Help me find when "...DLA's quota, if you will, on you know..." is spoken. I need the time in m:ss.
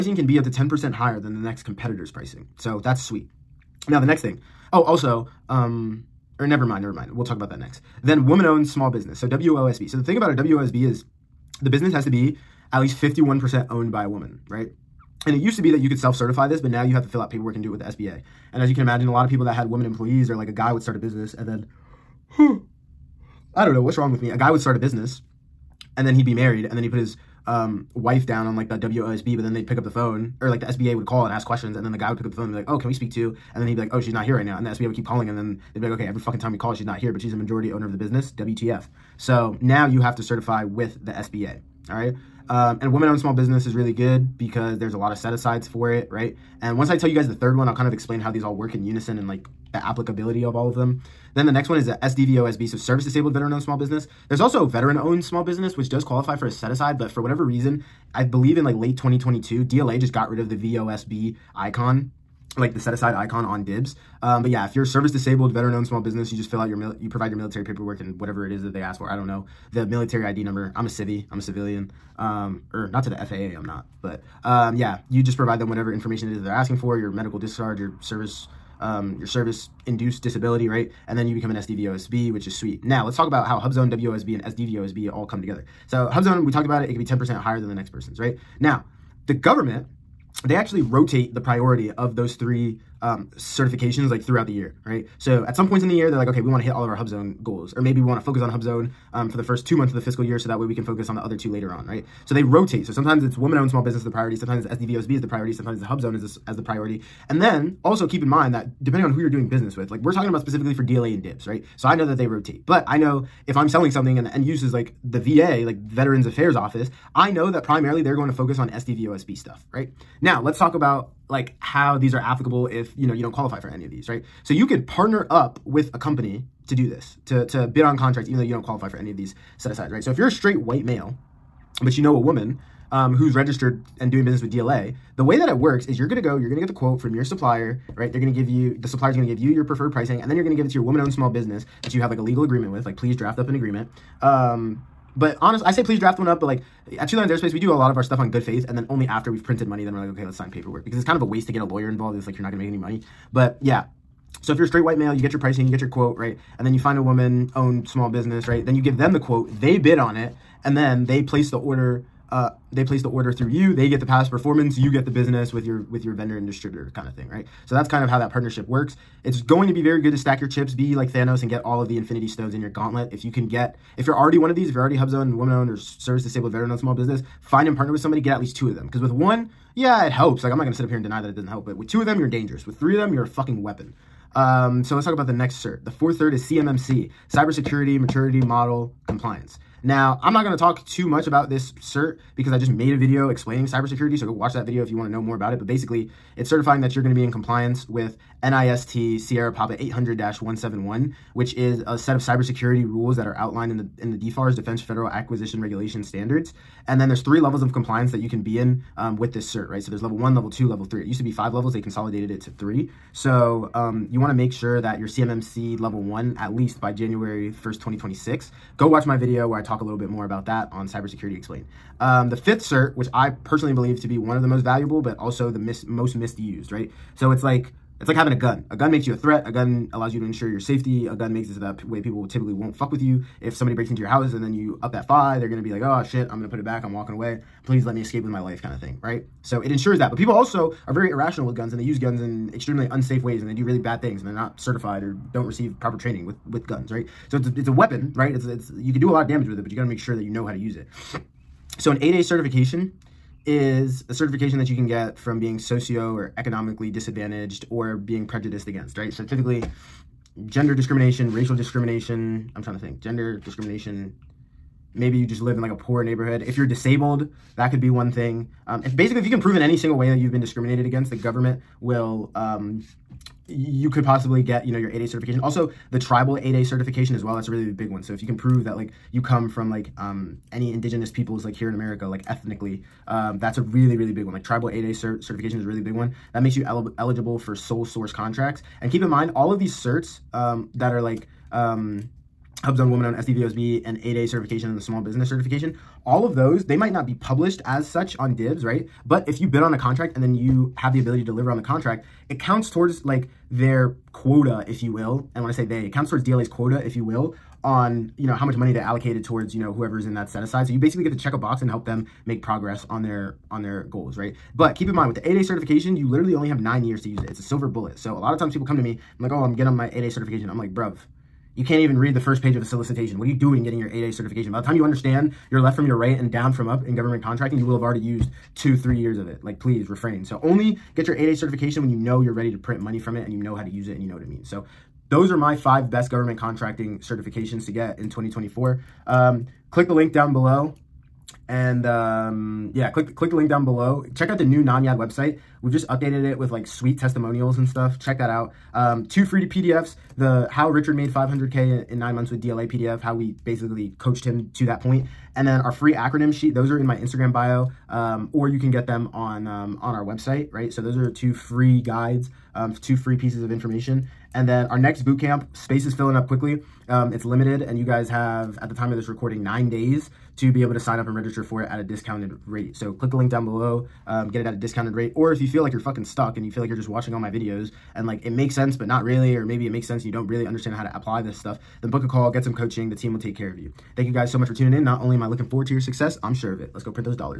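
5:06.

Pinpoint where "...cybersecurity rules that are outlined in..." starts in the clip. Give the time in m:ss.
3:22.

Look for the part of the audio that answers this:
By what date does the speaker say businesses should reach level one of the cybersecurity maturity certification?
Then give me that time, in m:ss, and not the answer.
3:36.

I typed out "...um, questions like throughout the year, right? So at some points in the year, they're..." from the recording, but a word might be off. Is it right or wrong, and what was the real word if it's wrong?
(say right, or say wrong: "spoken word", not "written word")
wrong: "certifications", not "questions".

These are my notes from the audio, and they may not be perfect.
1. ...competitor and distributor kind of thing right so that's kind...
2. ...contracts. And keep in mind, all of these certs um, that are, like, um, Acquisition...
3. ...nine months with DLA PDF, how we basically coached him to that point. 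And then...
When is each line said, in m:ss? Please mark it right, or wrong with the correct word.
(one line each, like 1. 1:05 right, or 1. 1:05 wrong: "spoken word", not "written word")
1. 2:46 wrong: "vendor", not "competitor"
2. 4:48 wrong: "HubZone", not "Acquisition"
3. 5:51 right.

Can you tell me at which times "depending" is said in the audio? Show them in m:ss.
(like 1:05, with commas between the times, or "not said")
1:48.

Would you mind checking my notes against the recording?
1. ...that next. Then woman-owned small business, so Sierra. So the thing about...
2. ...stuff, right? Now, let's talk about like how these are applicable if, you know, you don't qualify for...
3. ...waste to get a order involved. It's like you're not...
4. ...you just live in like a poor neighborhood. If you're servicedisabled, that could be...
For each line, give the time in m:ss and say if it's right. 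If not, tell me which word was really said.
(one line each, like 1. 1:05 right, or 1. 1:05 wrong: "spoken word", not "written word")
1. 0:07 wrong: "WOSB", not "Sierra"
2. 1:59 right
3. 2:31 wrong: "lawyer", not "order"
4. 4:25 wrong: "disabled", not "servicedisabled".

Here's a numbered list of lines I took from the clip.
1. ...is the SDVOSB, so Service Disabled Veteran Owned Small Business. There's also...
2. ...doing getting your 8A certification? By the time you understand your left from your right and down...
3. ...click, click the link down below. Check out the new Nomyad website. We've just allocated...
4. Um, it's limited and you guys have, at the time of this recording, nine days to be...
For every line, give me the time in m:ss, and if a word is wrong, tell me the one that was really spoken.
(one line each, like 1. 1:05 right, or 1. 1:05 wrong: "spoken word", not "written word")
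1. 0:51 right
2. 5:23 right
3. 5:42 wrong: "updated", not "allocated"
4. 6:06 right.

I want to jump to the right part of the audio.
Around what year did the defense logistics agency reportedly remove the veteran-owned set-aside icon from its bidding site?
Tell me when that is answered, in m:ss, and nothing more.
0:58.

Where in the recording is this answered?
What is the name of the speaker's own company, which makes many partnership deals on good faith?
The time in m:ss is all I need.
2:27.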